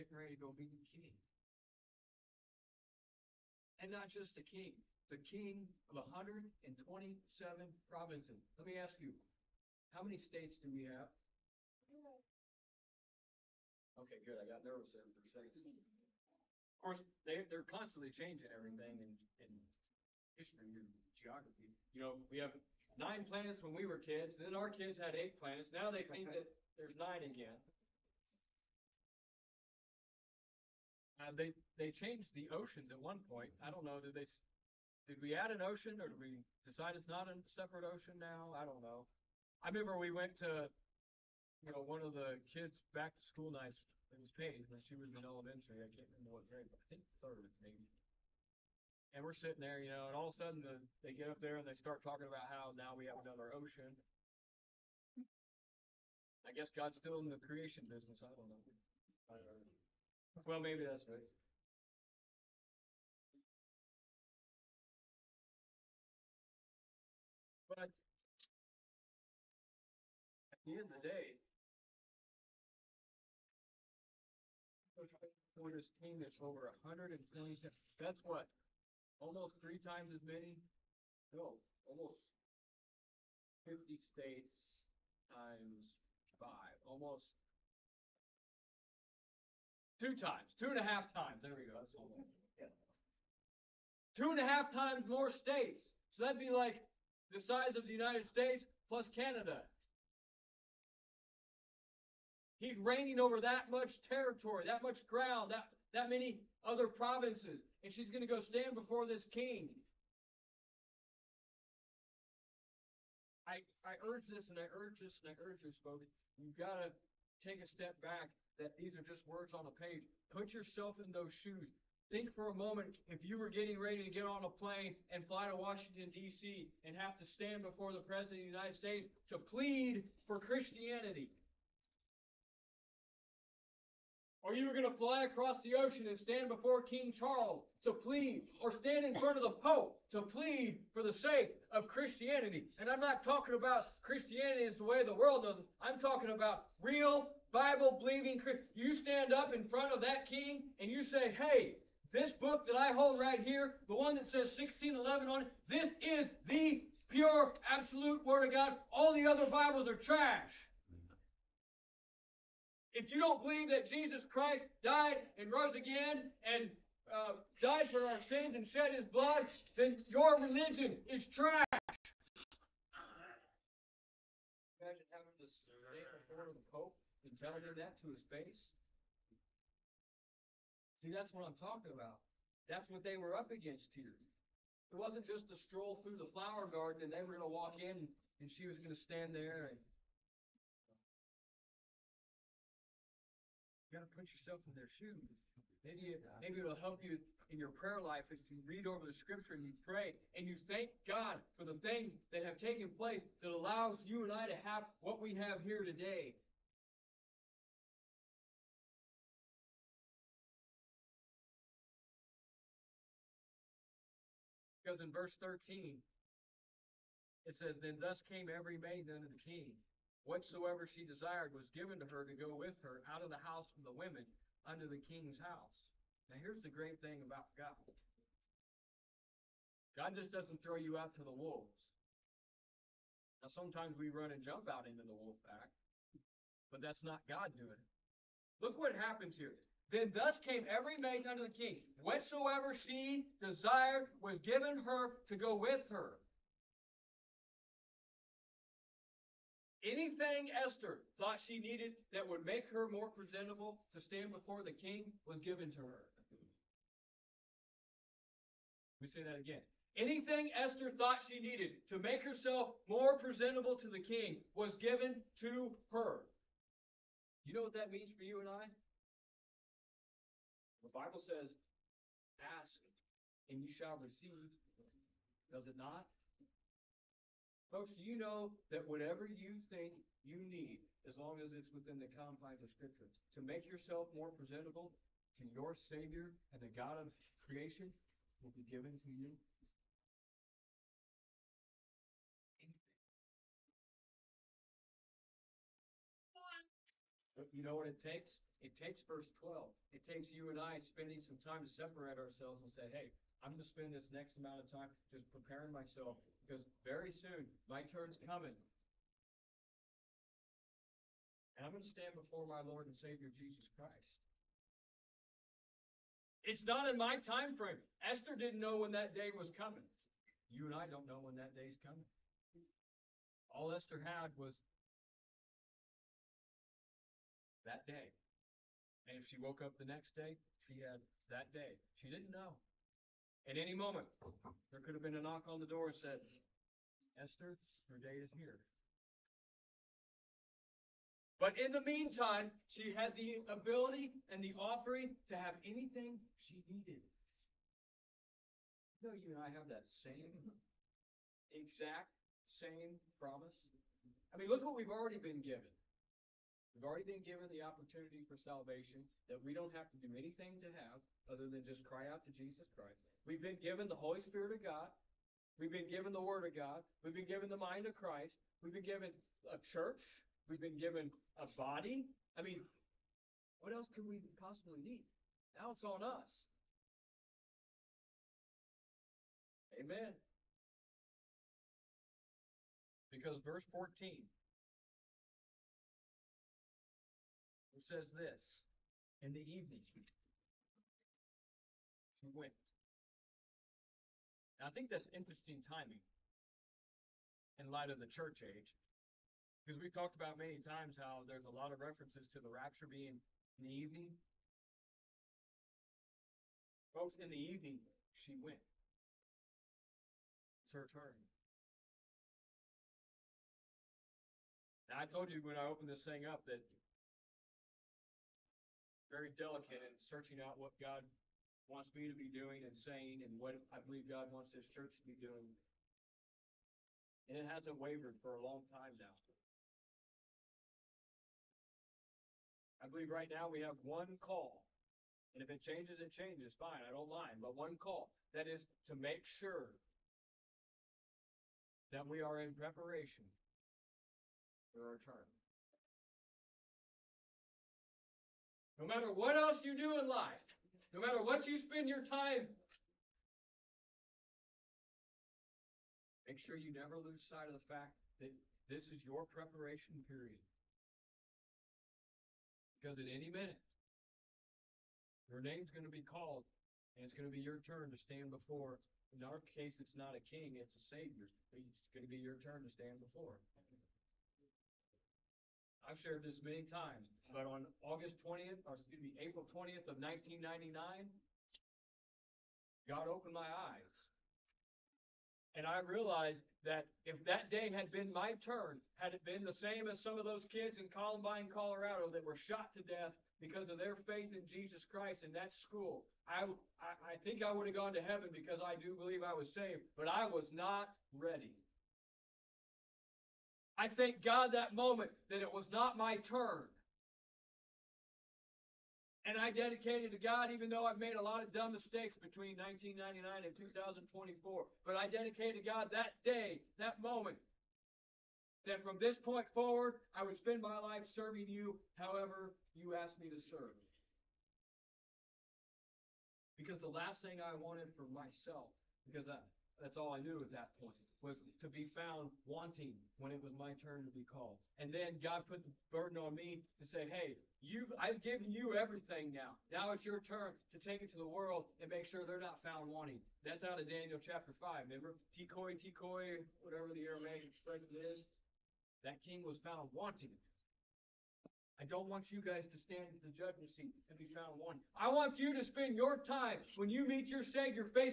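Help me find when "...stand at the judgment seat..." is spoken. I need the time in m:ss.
9:12.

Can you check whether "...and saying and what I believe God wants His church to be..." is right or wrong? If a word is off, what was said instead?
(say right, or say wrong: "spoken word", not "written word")
right.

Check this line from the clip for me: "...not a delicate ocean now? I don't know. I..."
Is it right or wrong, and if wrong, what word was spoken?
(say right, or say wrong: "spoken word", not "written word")
wrong: "separate", not "delicate".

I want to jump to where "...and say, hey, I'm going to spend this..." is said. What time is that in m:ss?
5:02.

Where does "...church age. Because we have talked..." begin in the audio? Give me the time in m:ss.
6:38.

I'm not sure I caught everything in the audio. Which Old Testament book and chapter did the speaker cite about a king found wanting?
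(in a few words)
Daniel chapter 5.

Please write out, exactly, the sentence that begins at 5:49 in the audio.
You know, you and I have that same, exact same promise.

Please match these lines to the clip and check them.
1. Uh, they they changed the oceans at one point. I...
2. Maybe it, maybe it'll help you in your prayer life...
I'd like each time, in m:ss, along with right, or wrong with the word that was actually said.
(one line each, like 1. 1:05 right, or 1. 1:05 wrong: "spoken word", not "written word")
1. 0:31 right
2. 3:15 right.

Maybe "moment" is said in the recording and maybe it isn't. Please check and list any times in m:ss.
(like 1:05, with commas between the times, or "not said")
2:02, 5:33, 8:24, 8:37.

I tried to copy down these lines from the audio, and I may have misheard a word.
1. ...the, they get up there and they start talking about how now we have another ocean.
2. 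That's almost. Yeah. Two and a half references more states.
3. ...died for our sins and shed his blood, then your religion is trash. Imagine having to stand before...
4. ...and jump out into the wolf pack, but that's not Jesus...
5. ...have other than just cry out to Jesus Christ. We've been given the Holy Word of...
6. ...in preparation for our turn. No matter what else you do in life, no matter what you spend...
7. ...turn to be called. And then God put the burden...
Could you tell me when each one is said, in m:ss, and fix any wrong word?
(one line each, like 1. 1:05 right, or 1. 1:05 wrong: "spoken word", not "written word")
1. 0:50 right
2. 1:31 wrong: "times", not "references"
3. 2:47 right
4. 3:54 wrong: "God", not "Jesus"
5. 6:00 wrong: "Spirit", not "Word"
6. 7:22 right
7. 8:53 right.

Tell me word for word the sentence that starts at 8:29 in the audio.
And I dedicated to God, even though I've made a lot of dumb mistakes between 1999 and 2024.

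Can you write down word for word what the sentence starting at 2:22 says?
And I'm not talking about Christianity as the way the world knows it.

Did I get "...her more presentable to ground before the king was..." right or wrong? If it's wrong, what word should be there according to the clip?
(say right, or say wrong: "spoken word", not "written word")
wrong: "stand", not "ground".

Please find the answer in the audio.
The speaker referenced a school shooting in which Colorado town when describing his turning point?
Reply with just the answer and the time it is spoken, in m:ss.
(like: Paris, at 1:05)
Columbine, at 8:10.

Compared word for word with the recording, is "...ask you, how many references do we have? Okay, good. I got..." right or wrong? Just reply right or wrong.
wrong.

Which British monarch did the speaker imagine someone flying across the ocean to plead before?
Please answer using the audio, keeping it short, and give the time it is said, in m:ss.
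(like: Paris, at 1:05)
King Charles, at 2:16.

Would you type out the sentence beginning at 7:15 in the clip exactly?
And if it changes, it changes.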